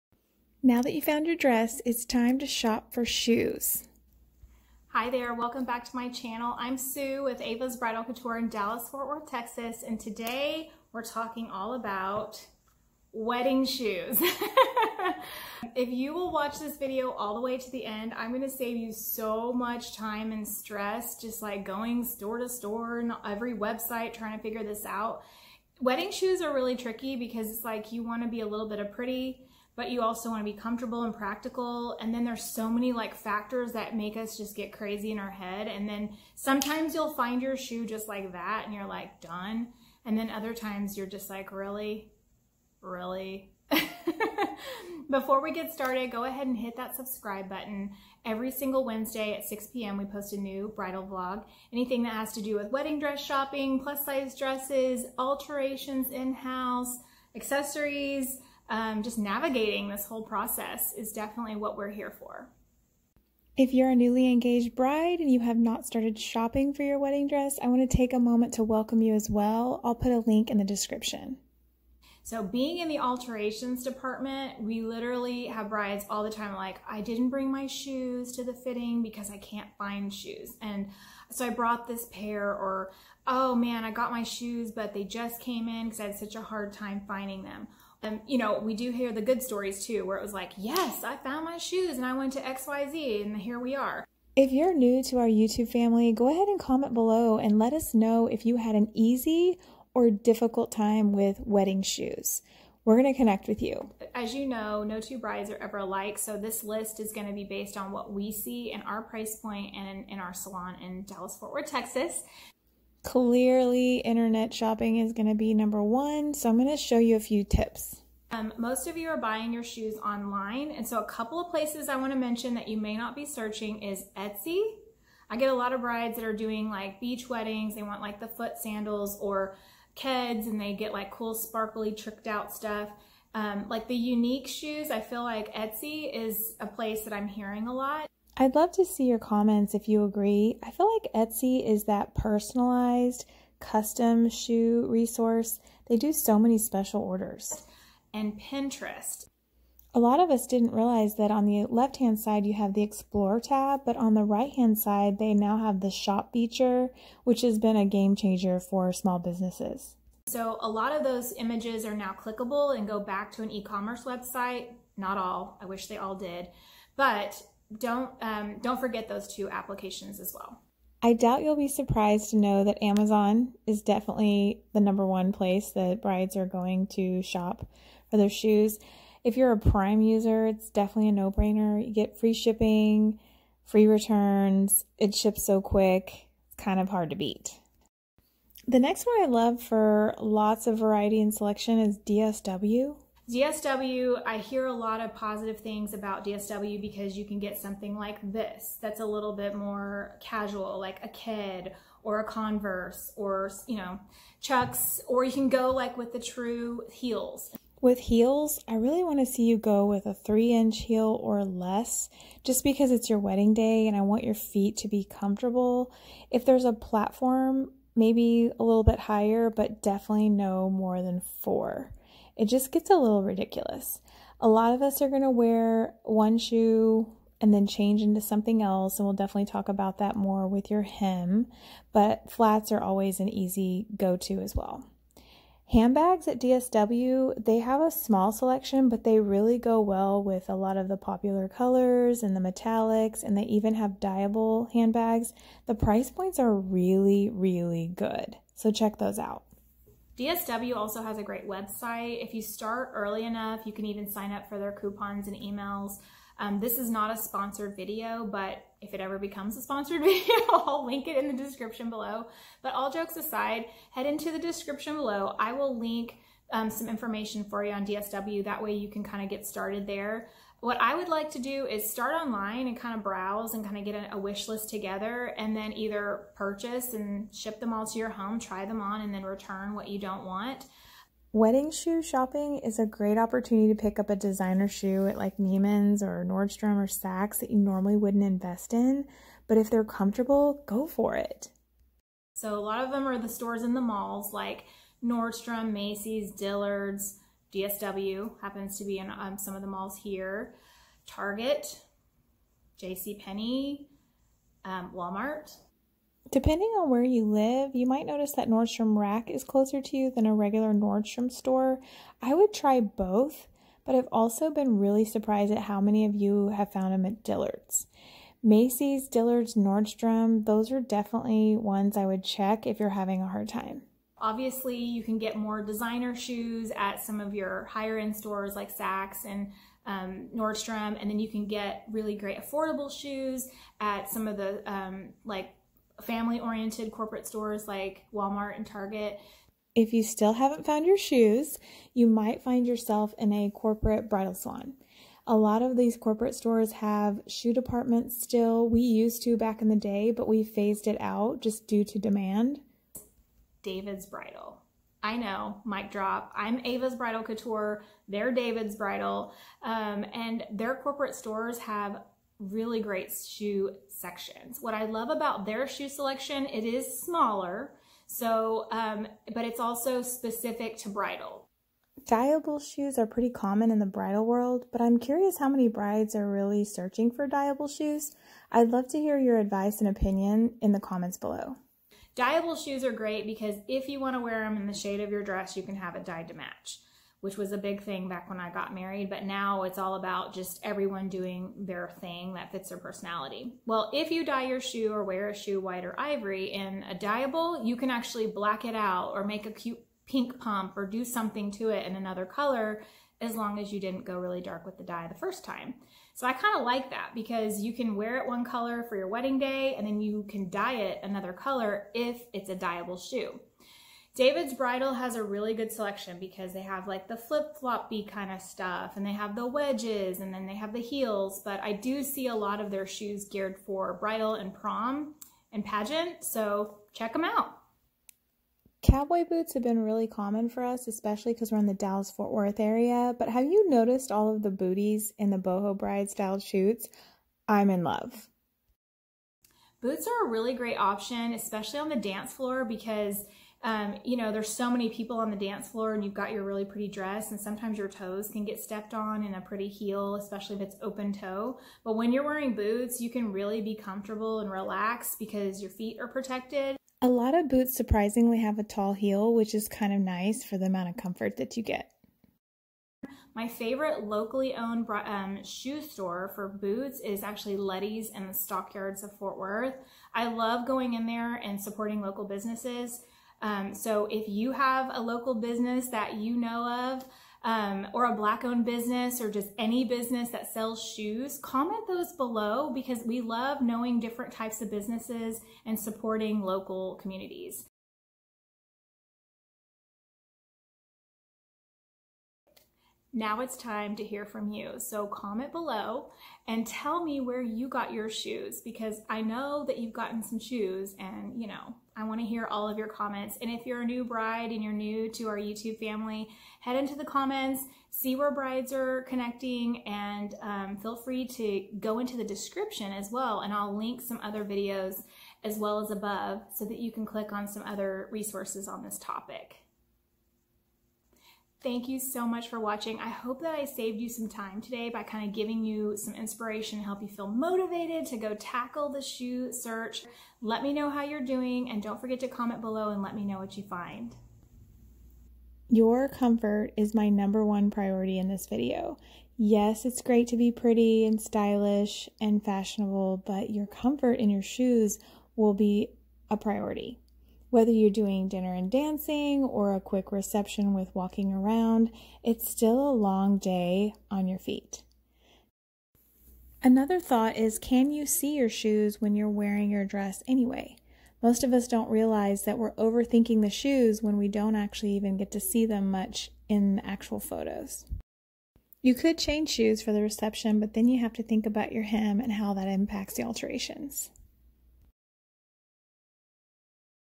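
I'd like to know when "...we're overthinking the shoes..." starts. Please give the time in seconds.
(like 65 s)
562 s.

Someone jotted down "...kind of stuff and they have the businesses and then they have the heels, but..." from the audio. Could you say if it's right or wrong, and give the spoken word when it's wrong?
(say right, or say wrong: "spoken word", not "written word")
wrong: "wedges", not "businesses".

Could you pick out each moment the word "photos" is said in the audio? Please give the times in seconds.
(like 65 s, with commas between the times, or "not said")
567 s.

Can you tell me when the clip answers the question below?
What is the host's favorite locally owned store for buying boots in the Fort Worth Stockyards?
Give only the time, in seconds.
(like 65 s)
467 s.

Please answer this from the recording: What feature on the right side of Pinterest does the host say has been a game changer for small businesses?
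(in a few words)
Shop feature.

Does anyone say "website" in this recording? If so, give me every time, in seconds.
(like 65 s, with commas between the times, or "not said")
23 s, 164 s, 251 s.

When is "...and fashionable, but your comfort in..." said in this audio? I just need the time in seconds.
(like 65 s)
542 s.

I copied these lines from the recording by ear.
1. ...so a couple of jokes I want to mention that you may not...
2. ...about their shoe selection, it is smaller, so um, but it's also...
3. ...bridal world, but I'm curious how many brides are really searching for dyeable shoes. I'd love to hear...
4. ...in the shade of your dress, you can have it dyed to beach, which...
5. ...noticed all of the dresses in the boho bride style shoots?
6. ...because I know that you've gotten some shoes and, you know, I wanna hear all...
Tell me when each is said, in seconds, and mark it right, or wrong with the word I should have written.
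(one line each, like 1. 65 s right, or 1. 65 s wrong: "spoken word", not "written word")
1. 120 s wrong: "places", not "jokes"
2. 365 s right
3. 373 s right
4. 384 s wrong: "match", not "beach"
5. 433 s wrong: "booties", not "dresses"
6. 498 s right.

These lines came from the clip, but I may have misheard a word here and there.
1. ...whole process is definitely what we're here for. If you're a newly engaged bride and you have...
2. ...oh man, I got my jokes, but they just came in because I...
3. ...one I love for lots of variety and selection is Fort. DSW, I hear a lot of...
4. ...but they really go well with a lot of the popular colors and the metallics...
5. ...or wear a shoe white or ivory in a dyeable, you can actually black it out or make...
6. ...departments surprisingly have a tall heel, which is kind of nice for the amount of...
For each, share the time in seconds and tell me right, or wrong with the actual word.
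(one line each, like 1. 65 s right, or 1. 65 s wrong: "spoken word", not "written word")
1. 60 s right
2. 83 s wrong: "shoes", not "jokes"
3. 189 s wrong: "DSW", not "Fort"
4. 238 s right
5. 394 s right
6. 457 s wrong: "boots", not "departments".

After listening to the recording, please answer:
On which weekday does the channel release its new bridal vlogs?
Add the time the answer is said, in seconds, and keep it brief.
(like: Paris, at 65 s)
Wednesday, at 48 s.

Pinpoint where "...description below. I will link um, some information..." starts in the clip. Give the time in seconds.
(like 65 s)
264 s.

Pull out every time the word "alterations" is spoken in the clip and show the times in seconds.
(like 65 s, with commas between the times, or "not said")
55 s, 72 s, 573 s.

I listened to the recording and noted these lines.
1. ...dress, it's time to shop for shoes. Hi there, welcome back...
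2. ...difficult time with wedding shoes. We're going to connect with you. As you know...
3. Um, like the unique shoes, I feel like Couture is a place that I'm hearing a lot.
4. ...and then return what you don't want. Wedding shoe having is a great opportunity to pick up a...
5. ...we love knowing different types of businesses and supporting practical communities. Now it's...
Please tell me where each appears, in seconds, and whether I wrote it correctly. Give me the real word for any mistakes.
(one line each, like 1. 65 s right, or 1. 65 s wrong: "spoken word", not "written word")
1. 1 s right
2. 100 s right
3. 133 s wrong: "Etsy", not "Couture"
4. 279 s wrong: "shopping", not "having"
5. 483 s wrong: "local", not "practical".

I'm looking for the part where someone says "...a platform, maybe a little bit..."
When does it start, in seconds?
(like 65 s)
216 s.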